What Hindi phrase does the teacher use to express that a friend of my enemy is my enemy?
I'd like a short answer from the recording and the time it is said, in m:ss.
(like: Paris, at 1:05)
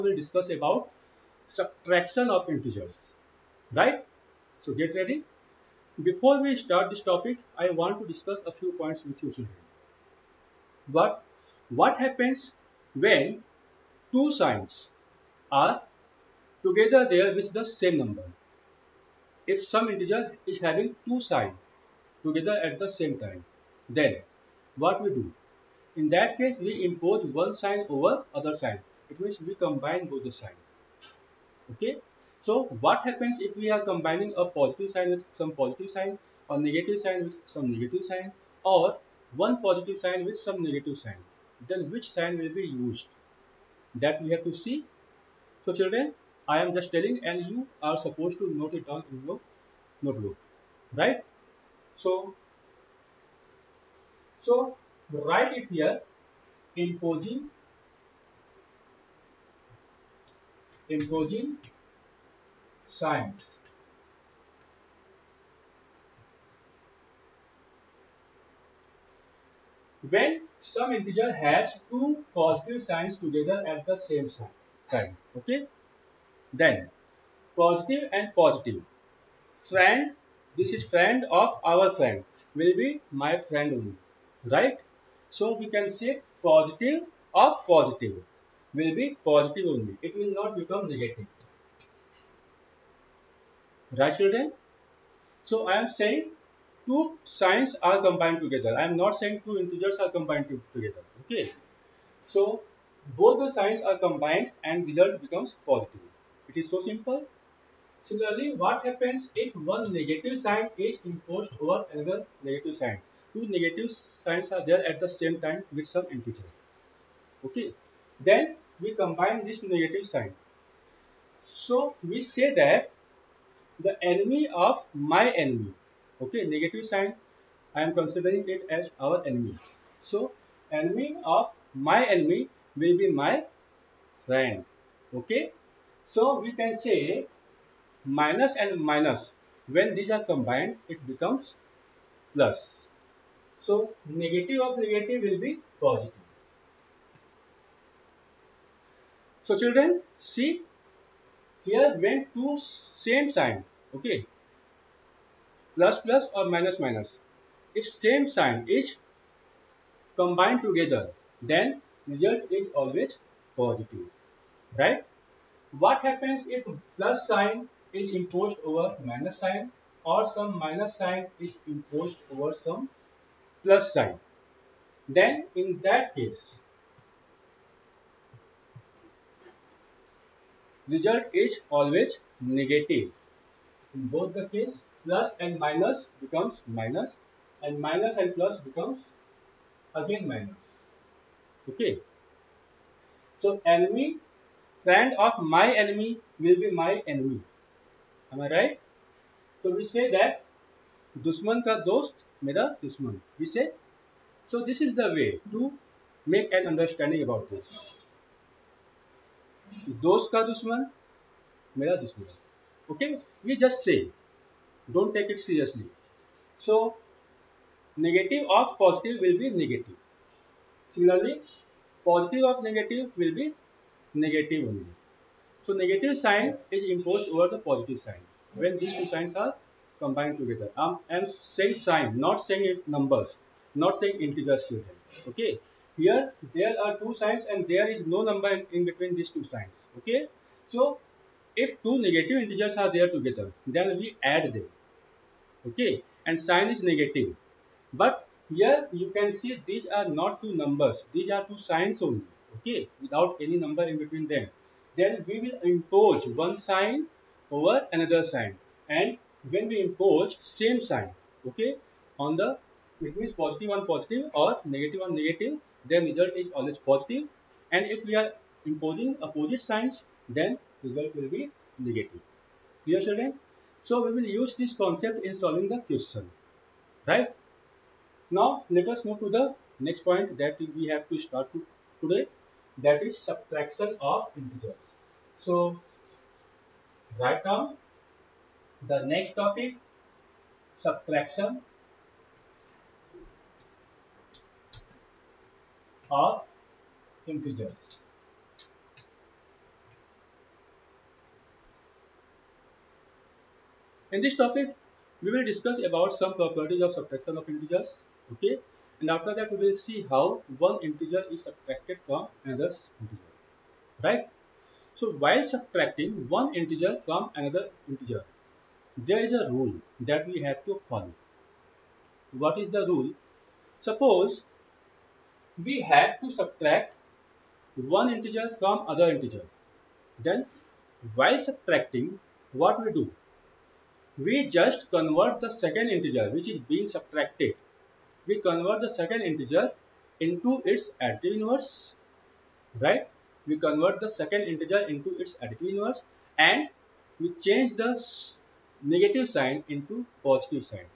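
dushman ka dost mera dushman, at 3:21.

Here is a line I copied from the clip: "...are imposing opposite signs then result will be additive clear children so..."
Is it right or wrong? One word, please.
wrong.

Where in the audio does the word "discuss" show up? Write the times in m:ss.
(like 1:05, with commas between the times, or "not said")
0:00, 0:08, 5:05.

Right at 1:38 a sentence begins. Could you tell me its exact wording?
I am not saying two integers are combined together.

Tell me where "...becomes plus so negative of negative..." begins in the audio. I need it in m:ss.
2:21.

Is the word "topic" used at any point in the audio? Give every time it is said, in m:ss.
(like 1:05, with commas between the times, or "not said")
0:07, 4:49, 5:04.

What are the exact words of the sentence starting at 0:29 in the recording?
It means we combine both the signs.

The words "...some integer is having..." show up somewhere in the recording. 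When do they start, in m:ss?
0:19.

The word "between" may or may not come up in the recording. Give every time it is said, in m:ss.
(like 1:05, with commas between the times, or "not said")
3:58, 4:14.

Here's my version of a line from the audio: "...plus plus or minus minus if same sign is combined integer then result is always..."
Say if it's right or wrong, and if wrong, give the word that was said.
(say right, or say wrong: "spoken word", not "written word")
wrong: "together", not "integer".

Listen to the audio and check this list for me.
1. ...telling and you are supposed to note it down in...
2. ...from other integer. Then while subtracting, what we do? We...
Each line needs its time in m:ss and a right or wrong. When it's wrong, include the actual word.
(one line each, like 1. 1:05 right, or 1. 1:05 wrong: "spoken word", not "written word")
1. 0:46 right
2. 5:28 right.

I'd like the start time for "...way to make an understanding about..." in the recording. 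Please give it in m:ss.
3:25.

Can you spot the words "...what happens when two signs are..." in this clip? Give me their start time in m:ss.
0:11.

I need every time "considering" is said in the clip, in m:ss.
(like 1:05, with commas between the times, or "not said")
2:07.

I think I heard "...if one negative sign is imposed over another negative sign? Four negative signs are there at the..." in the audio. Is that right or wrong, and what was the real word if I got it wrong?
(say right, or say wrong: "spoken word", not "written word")
wrong: "Two", not "Four".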